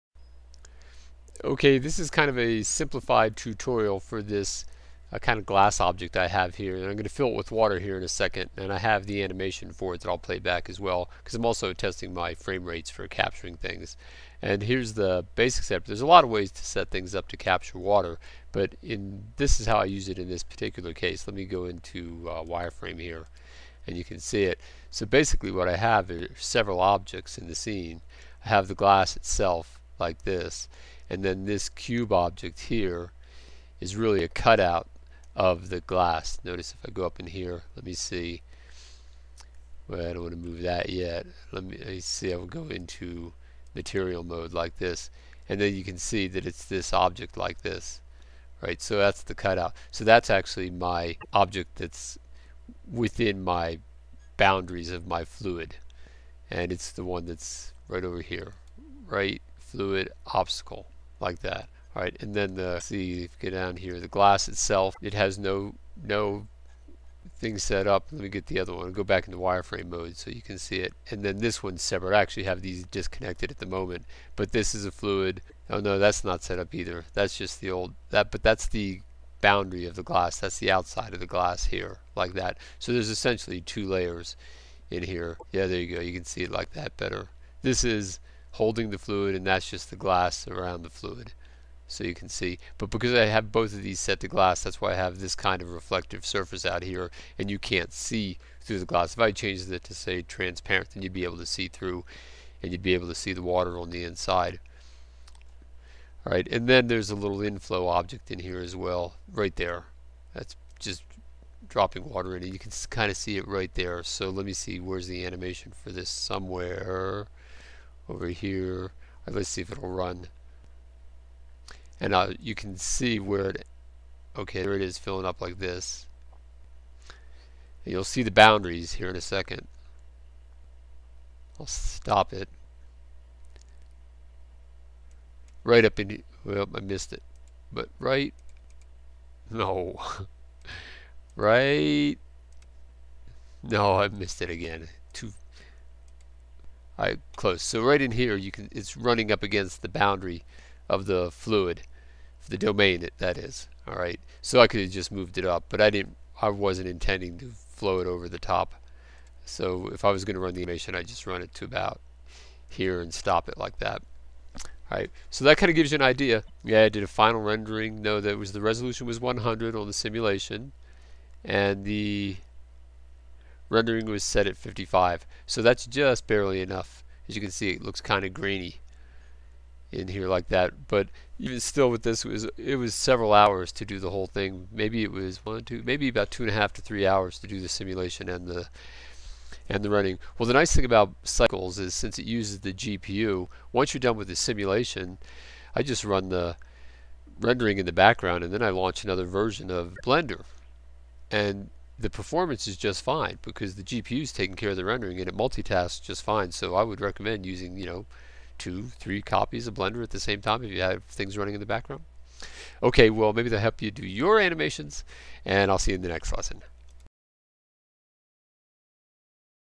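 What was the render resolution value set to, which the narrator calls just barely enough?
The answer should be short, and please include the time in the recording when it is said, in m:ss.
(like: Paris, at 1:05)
55, at 2:54.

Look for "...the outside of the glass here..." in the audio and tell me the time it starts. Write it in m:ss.
1:20.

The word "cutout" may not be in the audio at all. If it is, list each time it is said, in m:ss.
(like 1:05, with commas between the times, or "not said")
0:34, 0:49.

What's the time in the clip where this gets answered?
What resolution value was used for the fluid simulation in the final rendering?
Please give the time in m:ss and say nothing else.
2:49.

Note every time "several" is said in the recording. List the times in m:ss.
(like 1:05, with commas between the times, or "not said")
0:26, 3:02.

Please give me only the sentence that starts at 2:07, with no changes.
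And you'll see the boundaries here in a second.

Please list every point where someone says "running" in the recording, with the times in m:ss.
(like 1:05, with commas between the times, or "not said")
2:28, 3:09, 3:31.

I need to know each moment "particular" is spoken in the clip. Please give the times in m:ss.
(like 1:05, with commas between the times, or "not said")
0:20.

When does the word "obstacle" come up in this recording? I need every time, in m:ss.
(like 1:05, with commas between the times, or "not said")
1:00.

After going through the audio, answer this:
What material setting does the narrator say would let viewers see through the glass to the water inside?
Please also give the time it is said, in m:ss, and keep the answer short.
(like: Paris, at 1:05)
Transparent, at 1:40.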